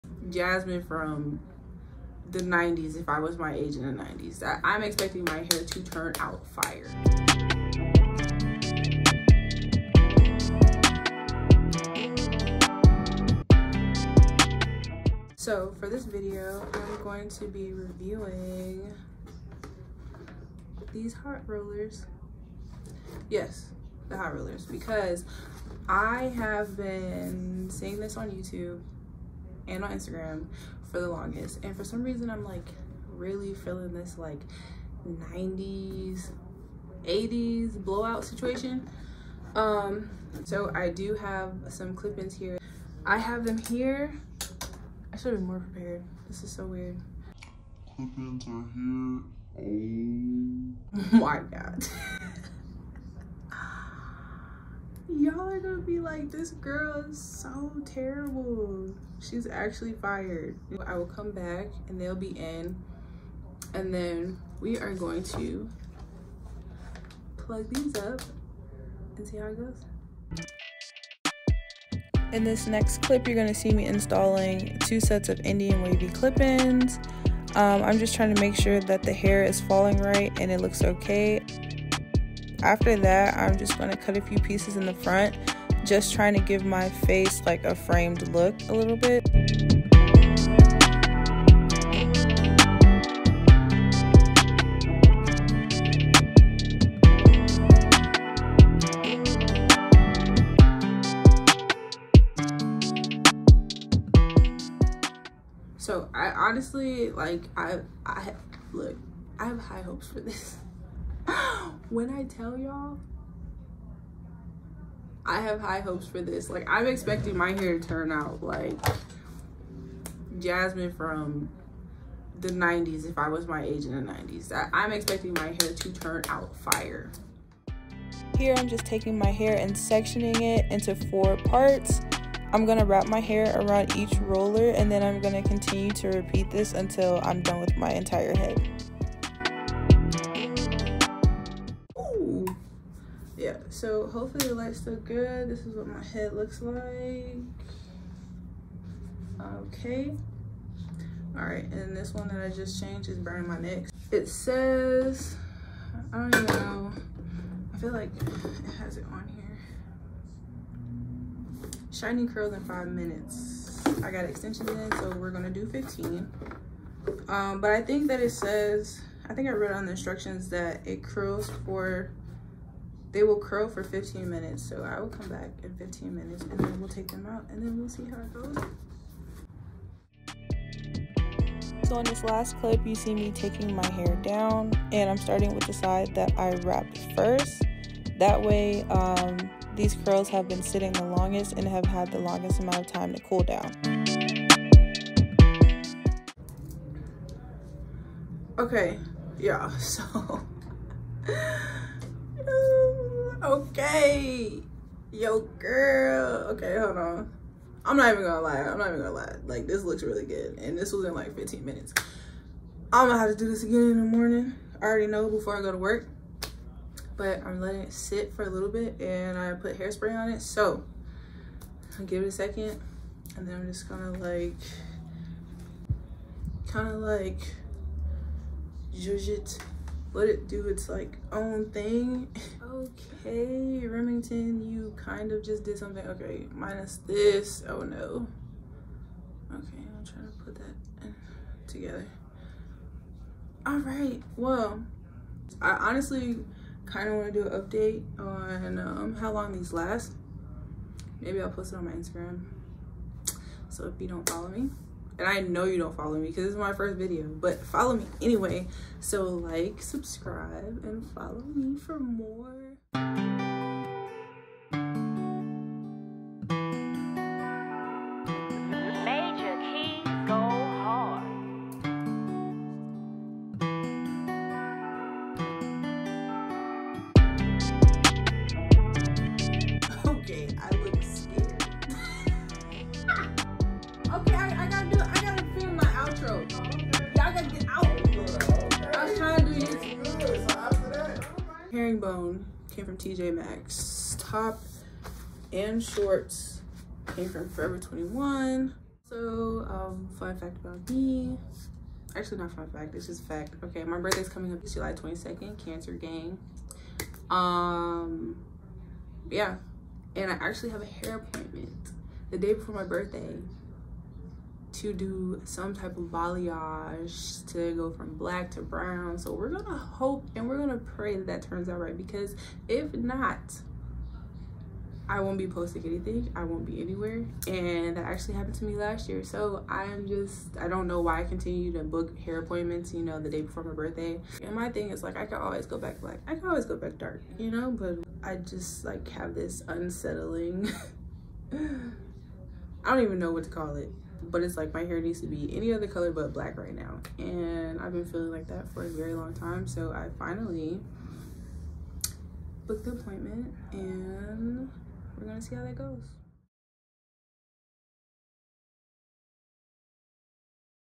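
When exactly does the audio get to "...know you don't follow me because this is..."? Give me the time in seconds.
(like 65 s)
255 s.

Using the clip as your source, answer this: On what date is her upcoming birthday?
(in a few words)
July 22.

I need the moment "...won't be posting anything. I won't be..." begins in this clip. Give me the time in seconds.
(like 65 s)
325 s.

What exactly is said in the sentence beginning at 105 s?
So I honestly like I I look I have high hopes for this.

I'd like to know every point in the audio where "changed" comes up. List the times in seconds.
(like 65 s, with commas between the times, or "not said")
152 s.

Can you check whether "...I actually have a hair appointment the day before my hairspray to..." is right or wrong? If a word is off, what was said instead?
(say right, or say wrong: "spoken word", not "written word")
wrong: "birthday", not "hairspray".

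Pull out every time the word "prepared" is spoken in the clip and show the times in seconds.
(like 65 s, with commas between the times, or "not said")
45 s.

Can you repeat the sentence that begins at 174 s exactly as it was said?
So I will come back in 15 minutes and then we'll take them out and then we'll see how it goes.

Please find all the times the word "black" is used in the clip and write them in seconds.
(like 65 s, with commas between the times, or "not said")
318 s, 335 s, 346 s.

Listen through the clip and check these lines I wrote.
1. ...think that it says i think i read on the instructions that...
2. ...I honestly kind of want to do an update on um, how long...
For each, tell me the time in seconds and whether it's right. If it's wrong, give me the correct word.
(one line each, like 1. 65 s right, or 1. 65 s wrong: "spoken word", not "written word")
1. 167 s right
2. 245 s right.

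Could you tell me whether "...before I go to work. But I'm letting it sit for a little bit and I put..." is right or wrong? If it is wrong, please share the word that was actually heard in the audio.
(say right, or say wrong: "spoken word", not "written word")
right.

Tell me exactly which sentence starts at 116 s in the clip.
Like, I'm expecting my hair to turn out like Jasmine from the 90s if I was my age in the 90s.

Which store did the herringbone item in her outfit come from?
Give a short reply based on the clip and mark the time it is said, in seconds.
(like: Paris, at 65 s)
TJ Maxx, at 292 s.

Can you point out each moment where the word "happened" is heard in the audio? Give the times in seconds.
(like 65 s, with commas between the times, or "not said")
328 s.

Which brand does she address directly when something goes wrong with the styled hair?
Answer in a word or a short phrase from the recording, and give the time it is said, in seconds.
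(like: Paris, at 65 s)
Remington, at 233 s.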